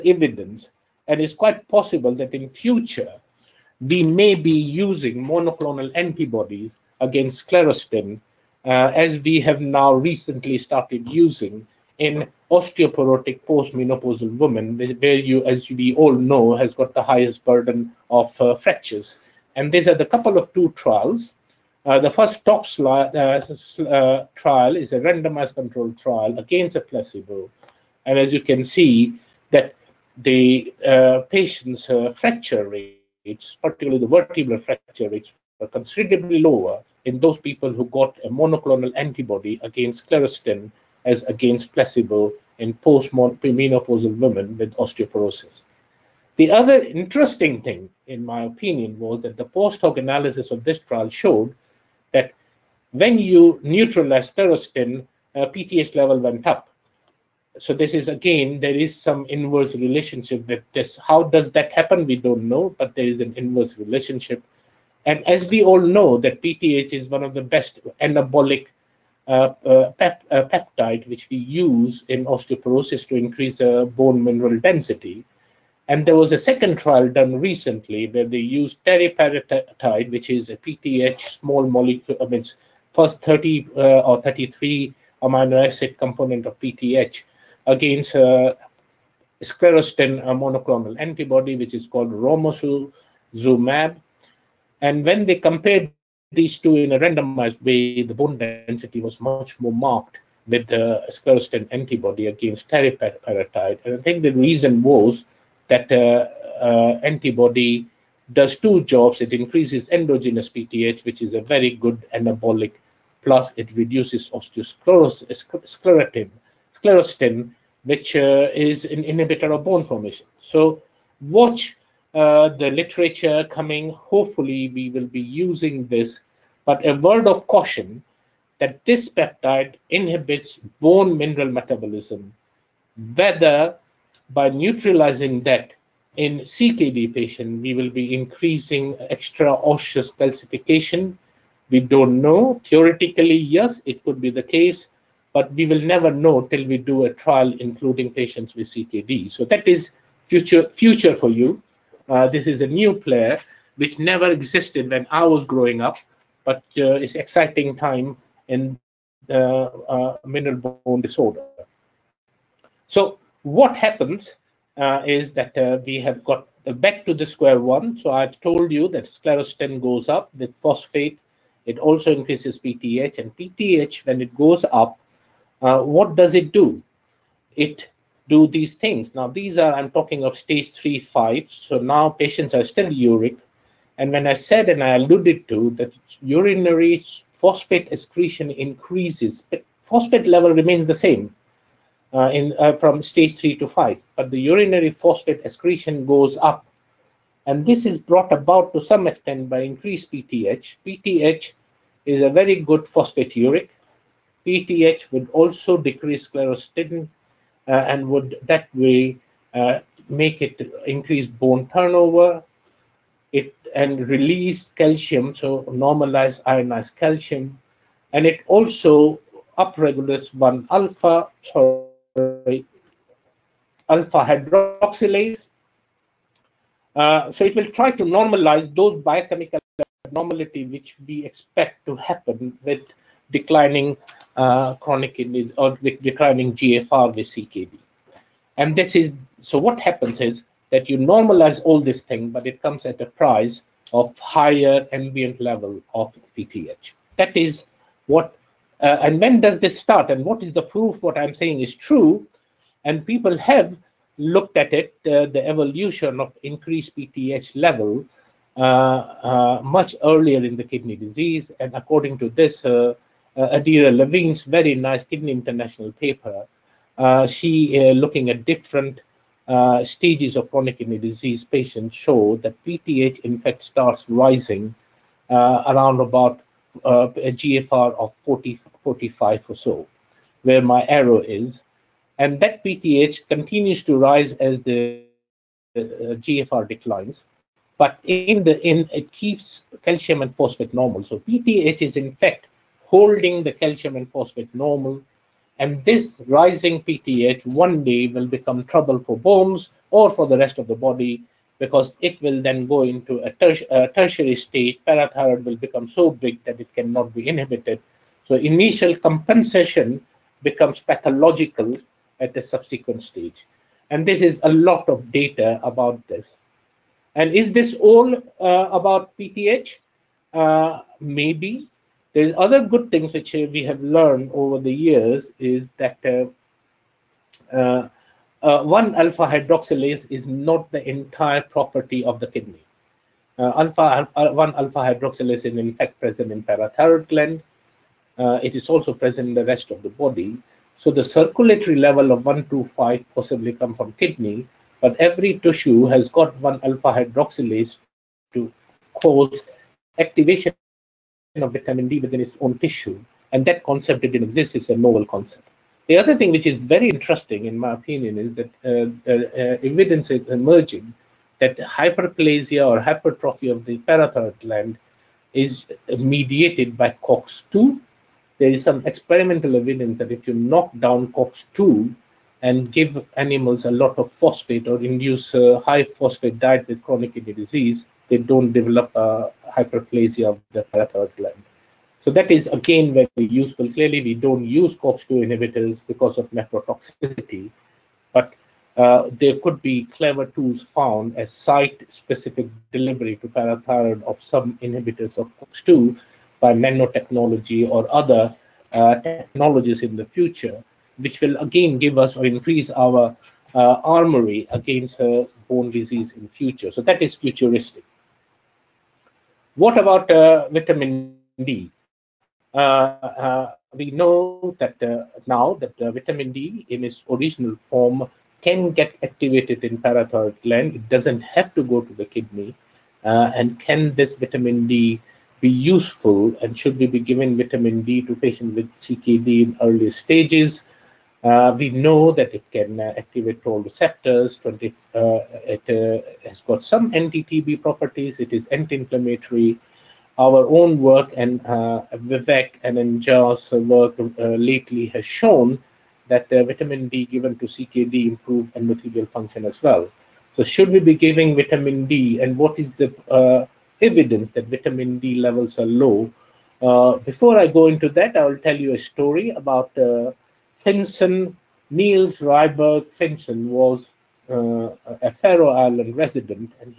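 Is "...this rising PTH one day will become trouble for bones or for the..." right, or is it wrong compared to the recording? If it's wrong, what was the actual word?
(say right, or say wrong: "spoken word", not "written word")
right.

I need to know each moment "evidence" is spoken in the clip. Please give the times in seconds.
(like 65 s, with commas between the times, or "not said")
0 s, 359 s, 369 s, 453 s.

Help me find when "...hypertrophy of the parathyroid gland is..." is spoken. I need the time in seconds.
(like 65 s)
362 s.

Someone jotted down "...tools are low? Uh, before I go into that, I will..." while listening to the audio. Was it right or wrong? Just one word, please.
wrong.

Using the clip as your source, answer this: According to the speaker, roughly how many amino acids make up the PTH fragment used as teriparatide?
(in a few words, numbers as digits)
33.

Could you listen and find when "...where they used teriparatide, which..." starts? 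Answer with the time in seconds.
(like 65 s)
78 s.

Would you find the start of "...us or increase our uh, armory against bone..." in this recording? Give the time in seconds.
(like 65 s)
401 s.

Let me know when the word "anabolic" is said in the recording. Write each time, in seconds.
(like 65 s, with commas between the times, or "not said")
68 s, 112 s.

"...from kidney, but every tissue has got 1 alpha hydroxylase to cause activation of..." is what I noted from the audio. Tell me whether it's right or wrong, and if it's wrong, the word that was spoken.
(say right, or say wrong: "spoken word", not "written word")
right.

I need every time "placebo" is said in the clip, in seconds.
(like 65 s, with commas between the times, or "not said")
26 s, 41 s.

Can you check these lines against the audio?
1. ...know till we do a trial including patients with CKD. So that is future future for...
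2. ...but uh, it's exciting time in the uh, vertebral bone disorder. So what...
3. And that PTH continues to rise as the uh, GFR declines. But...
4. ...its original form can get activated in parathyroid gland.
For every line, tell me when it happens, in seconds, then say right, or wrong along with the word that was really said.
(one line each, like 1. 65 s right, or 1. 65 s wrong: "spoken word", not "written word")
1. 146 s right
2. 156 s wrong: "mineral", not "vertebral"
3. 282 s right
4. 416 s right.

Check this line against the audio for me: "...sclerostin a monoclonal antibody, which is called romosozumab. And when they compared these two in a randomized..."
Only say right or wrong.
right.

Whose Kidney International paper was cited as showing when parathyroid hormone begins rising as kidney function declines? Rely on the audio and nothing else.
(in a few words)
Adeera Levin.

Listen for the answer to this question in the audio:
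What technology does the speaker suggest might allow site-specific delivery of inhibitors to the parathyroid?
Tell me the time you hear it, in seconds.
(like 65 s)
396 s.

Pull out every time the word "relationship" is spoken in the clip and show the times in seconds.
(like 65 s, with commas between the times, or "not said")
59 s, 63 s.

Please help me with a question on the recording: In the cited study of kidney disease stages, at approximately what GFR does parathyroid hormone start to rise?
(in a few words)
40-45.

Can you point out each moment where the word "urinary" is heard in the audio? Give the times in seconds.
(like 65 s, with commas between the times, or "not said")
186 s, 194 s.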